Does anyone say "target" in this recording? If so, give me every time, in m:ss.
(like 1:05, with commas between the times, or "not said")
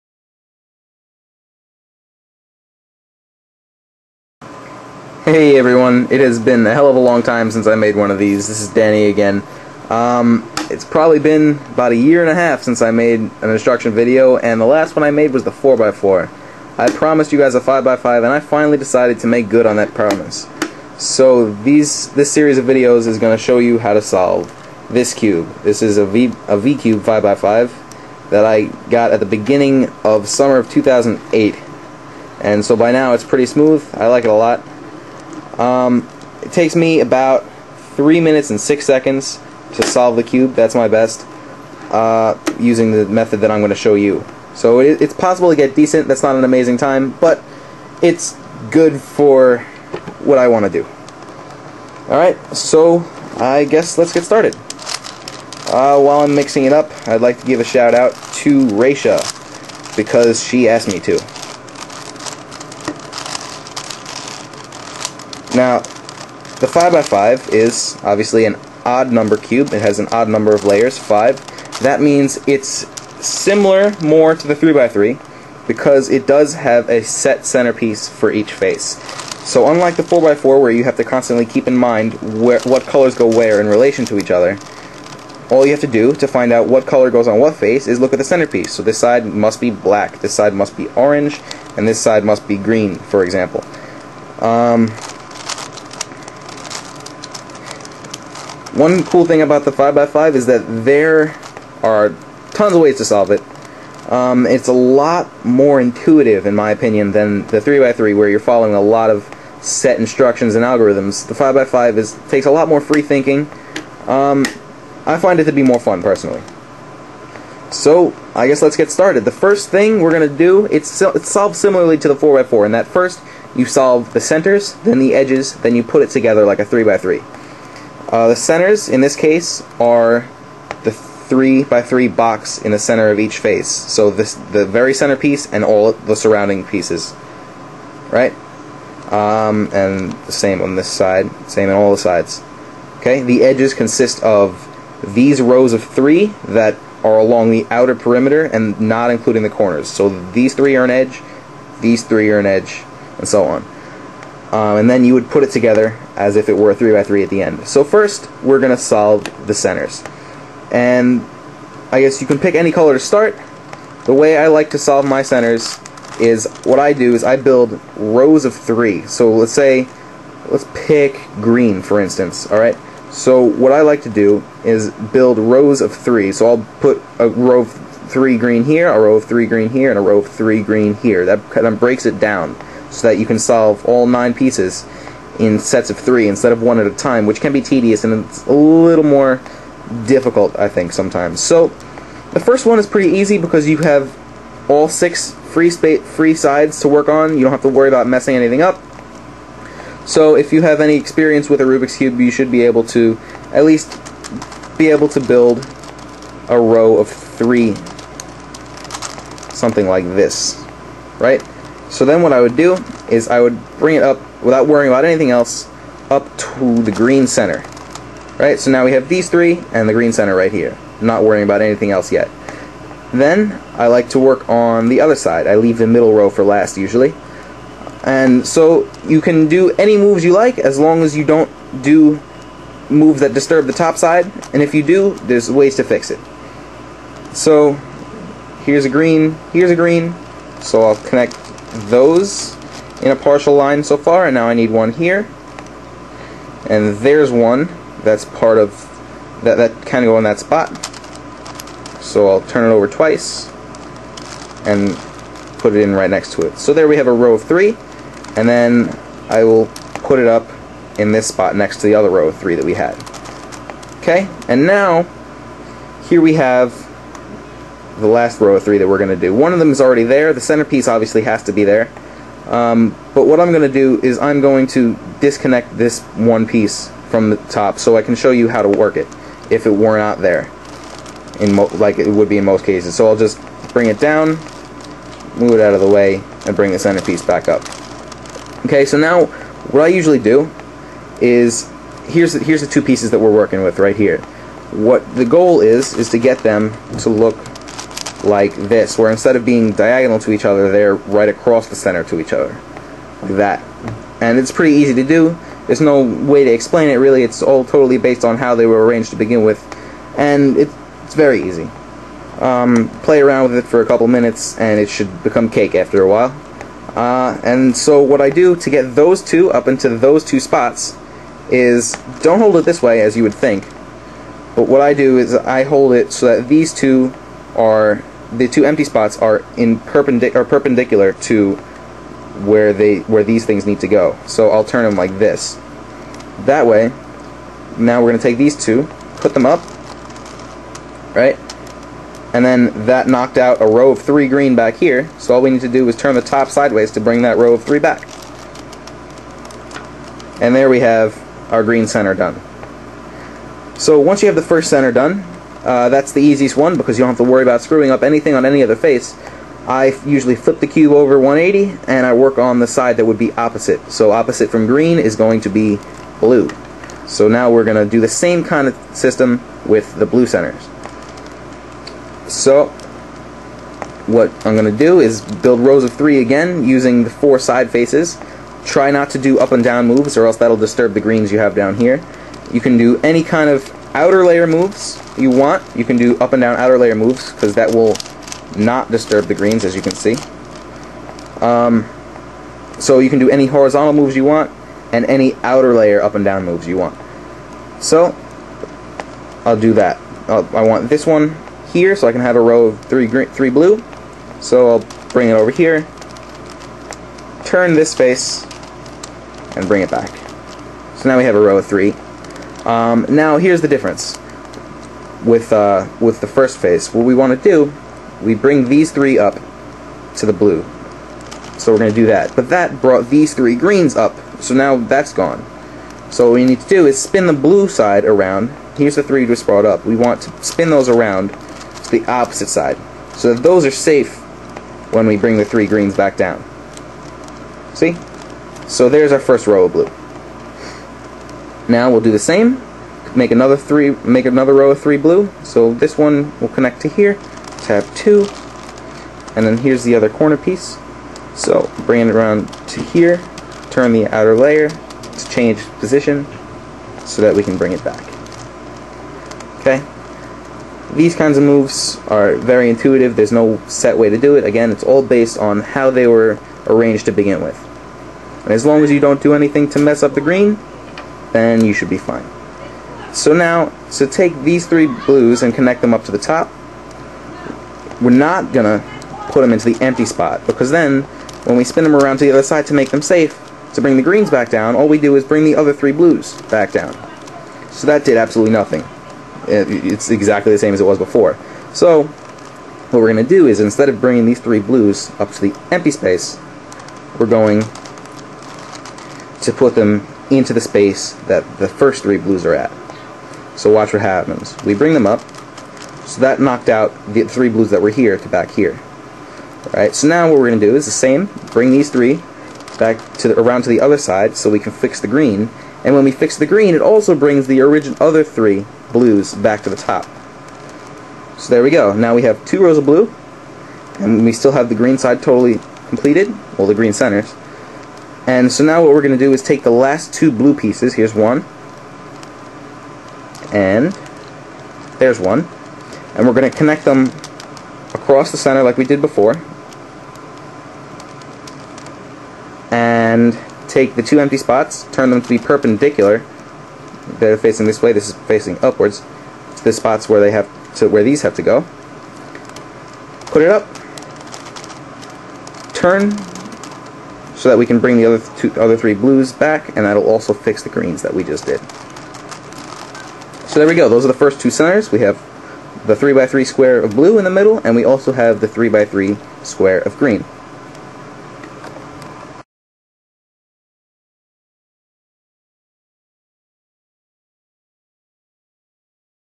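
not said.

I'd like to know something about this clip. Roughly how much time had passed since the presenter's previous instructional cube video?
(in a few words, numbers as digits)
a year and a half.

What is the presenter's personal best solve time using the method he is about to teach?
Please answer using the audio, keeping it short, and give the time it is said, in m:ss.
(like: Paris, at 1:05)
3 minutes 6 seconds, at 0:37.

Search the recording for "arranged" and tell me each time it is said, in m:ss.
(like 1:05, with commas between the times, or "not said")
5:08, 7:46.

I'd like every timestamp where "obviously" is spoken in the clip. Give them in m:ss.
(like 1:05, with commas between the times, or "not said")
1:08, 4:30.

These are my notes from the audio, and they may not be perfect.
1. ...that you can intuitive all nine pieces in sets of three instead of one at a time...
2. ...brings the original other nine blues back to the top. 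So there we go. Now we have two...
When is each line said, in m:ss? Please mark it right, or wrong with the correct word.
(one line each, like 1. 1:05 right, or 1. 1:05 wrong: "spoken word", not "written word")
1. 3:03 wrong: "solve", not "intuitive"
2. 8:37 wrong: "three", not "nine".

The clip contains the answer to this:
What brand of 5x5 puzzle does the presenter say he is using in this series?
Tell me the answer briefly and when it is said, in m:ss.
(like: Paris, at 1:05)
V-Cube, at 0:26.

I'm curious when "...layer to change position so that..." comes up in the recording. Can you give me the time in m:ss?
7:34.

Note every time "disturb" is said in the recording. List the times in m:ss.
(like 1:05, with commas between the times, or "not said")
3:53, 6:20, 6:28.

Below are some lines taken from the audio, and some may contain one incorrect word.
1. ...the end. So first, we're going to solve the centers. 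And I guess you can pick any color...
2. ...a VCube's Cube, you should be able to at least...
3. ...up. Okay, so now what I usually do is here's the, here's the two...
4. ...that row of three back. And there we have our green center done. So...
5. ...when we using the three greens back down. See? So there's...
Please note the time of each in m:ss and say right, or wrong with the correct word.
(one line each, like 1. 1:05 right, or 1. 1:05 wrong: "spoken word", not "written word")
1. 2:37 right
2. 3:21 wrong: "Rubik", not "VCube"
3. 4:47 right
4. 5:47 right
5. 7:14 wrong: "bring", not "using".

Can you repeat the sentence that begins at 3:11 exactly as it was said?
So the first one is pretty easy because you have all six free space, free sides to work on.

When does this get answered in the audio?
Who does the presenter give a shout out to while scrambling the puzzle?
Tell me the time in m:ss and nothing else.
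0:58.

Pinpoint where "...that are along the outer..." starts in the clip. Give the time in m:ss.
2:26.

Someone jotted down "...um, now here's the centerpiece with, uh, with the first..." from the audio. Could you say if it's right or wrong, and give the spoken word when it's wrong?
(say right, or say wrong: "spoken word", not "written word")
wrong: "difference", not "centerpiece".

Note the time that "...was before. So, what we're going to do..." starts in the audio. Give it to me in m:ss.
8:10.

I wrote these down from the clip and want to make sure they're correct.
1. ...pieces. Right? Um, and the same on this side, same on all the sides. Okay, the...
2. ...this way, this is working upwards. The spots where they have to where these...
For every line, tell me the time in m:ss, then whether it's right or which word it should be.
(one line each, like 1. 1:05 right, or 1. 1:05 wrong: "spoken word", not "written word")
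1. 2:16 right
2. 9:07 wrong: "facing", not "working".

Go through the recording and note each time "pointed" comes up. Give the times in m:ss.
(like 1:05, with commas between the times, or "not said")
not said.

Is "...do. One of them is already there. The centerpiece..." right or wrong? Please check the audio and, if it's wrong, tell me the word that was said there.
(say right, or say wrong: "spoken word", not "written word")
right.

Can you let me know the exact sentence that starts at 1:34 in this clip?
Um, one cool thing about the 5x5 is that there are tons of ways to solve it.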